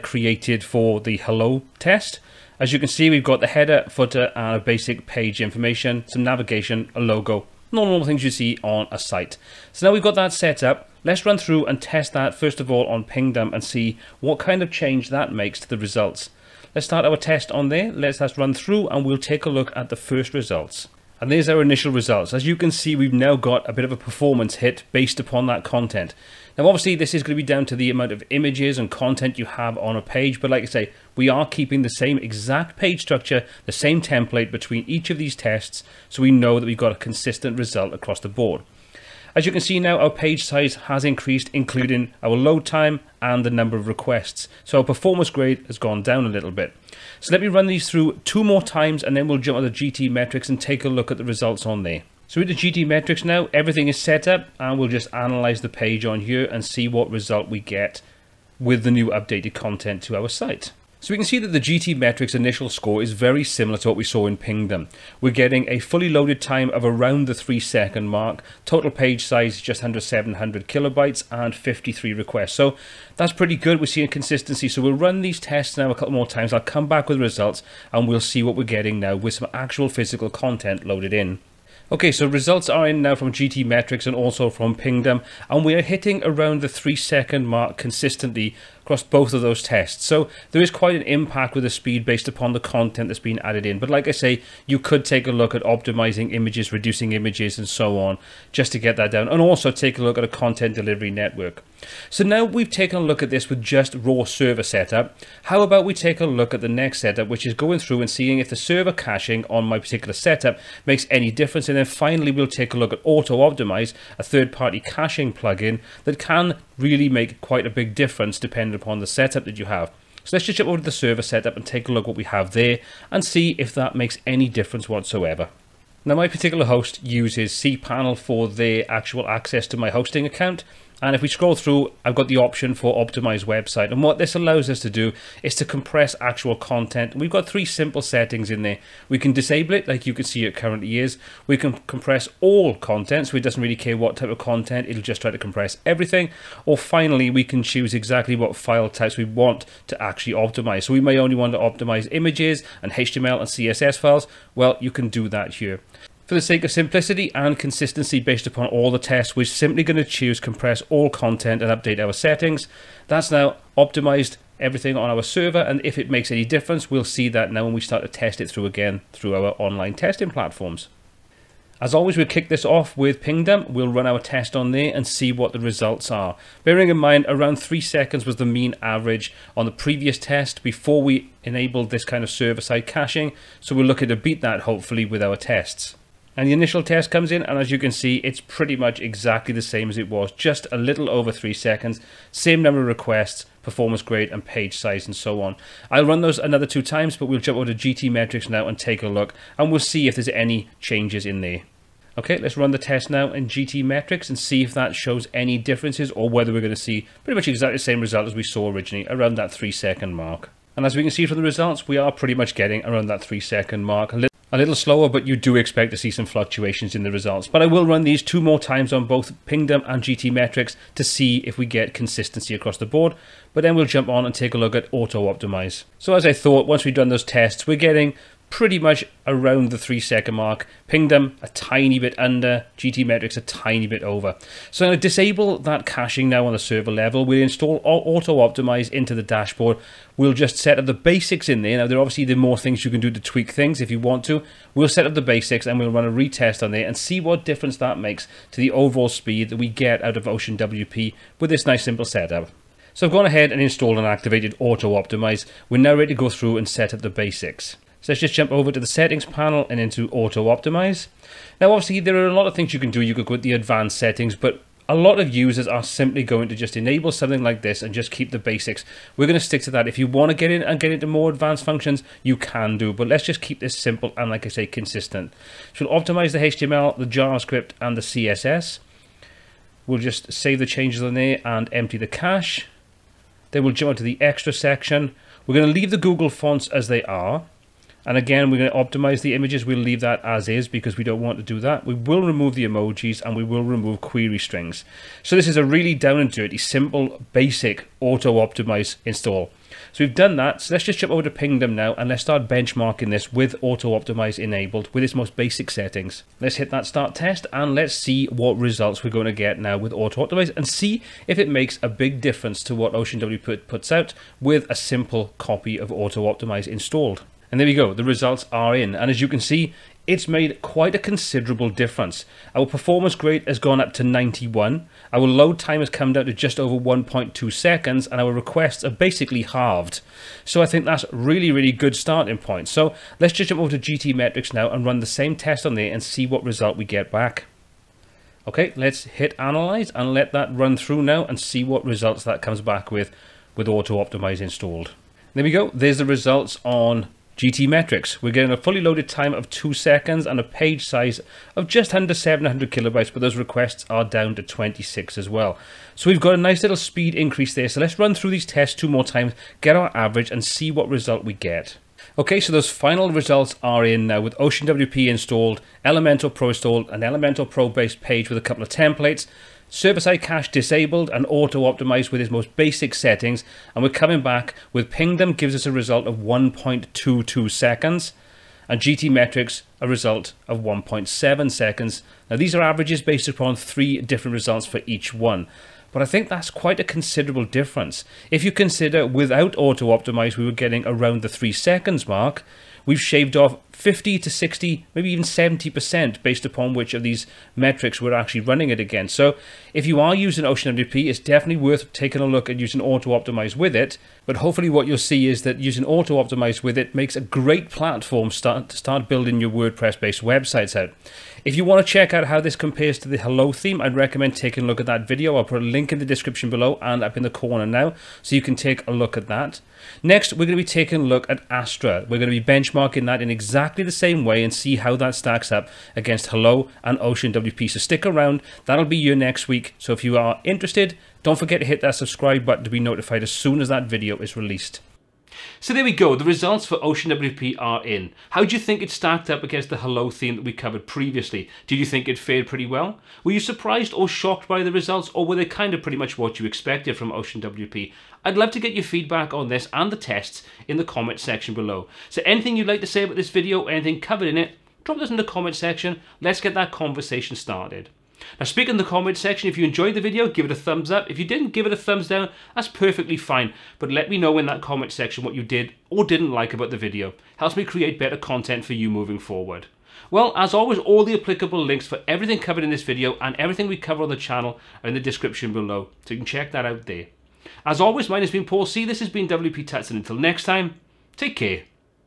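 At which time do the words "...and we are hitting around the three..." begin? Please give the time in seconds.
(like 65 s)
85 s.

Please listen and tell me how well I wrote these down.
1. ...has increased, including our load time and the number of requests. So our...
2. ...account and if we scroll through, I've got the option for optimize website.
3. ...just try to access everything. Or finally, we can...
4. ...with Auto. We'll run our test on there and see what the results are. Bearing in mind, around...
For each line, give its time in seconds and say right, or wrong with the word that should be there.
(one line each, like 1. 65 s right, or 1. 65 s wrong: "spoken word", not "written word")
1. 40 s right
2. 130 s right
3. 145 s wrong: "compress", not "access"
4. 172 s wrong: "Pingdom", not "Auto".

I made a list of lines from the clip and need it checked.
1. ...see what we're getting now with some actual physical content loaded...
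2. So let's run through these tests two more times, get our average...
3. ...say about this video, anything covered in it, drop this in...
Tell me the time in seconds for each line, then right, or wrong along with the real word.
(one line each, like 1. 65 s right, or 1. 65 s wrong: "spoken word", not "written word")
1. 78 s right
2. 357 s right
3. 452 s right.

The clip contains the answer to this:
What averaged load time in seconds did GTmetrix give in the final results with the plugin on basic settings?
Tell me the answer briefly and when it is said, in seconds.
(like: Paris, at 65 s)
1.7 seconds, at 380 s.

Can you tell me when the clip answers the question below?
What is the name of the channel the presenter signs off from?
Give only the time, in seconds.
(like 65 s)
479 s.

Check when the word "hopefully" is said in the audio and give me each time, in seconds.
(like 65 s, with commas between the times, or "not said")
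184 s, 404 s.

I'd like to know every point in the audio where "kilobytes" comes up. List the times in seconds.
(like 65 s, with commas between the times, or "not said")
70 s, 352 s.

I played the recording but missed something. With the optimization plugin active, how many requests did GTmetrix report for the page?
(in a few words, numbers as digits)
26.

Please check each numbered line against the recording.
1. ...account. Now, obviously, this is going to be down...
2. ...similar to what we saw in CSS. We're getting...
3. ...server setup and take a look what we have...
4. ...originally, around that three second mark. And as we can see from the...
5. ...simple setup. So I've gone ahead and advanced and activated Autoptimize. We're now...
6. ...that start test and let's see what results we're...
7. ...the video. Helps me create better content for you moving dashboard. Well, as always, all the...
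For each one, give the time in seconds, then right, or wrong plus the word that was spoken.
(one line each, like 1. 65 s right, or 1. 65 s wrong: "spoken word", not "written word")
1. 25 s wrong: "content", not "account"
2. 63 s wrong: "Pingdom", not "CSS"
3. 120 s right
4. 208 s right
5. 251 s wrong: "installed", not "advanced"
6. 306 s right
7. 466 s wrong: "forward", not "dashboard".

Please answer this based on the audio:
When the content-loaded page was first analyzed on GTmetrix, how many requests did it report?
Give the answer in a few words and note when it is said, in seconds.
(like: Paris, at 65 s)
53, at 71 s.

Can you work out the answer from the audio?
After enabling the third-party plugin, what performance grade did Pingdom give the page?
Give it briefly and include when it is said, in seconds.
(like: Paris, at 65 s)
91, at 324 s.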